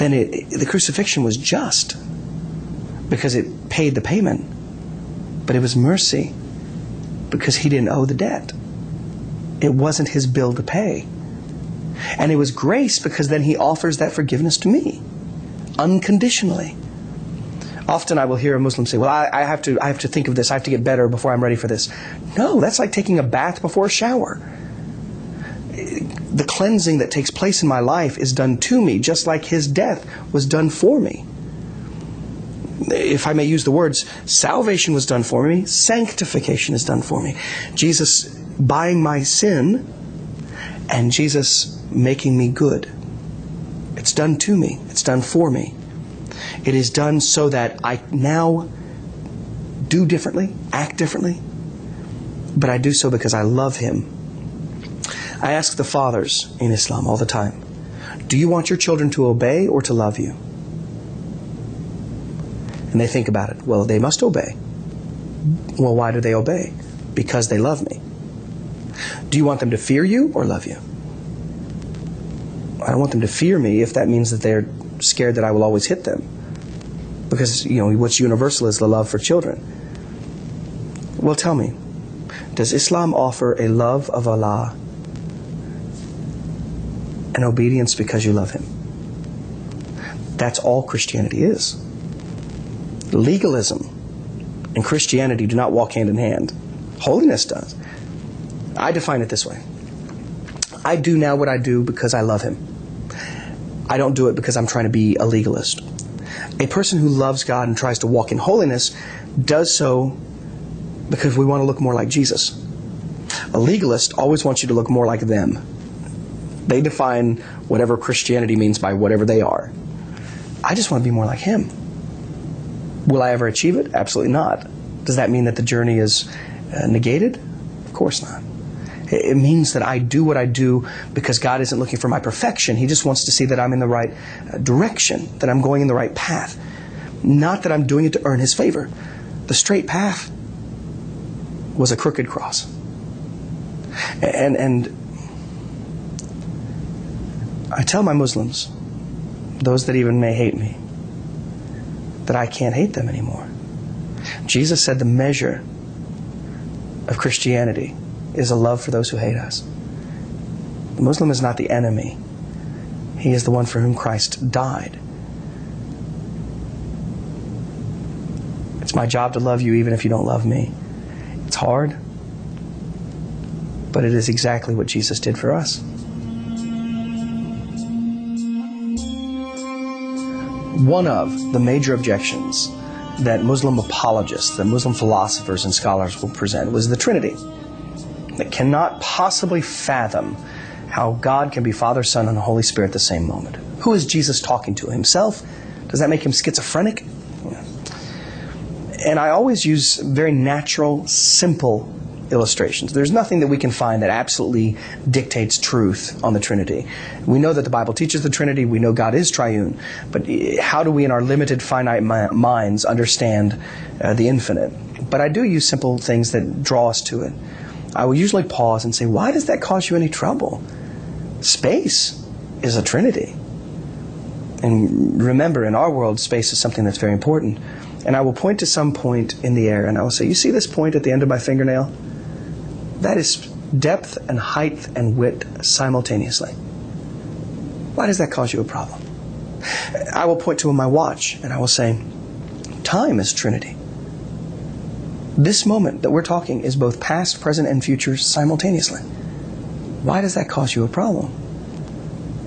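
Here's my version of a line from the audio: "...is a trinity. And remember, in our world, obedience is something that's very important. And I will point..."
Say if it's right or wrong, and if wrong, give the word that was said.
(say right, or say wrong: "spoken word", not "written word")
wrong: "space", not "obedience".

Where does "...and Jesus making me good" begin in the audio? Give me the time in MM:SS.
00:40.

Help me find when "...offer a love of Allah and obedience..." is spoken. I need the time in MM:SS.
01:23.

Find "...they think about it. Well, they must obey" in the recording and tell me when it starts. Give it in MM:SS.
01:02.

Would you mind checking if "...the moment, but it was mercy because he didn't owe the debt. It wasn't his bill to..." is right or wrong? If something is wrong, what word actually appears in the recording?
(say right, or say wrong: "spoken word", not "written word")
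wrong: "payment", not "moment".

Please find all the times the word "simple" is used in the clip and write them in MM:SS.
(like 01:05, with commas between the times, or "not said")
03:21, 03:35.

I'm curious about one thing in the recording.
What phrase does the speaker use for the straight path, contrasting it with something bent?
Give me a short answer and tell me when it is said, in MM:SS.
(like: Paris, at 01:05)
A crooked cross, at 02:21.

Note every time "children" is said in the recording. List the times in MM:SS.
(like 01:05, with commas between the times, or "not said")
00:58, 01:19.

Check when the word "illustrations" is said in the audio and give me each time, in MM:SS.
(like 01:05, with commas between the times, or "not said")
03:22.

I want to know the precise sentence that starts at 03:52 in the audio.
That is depth and height and width simultaneously.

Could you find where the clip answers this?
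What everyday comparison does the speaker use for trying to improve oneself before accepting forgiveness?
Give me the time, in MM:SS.
00:22.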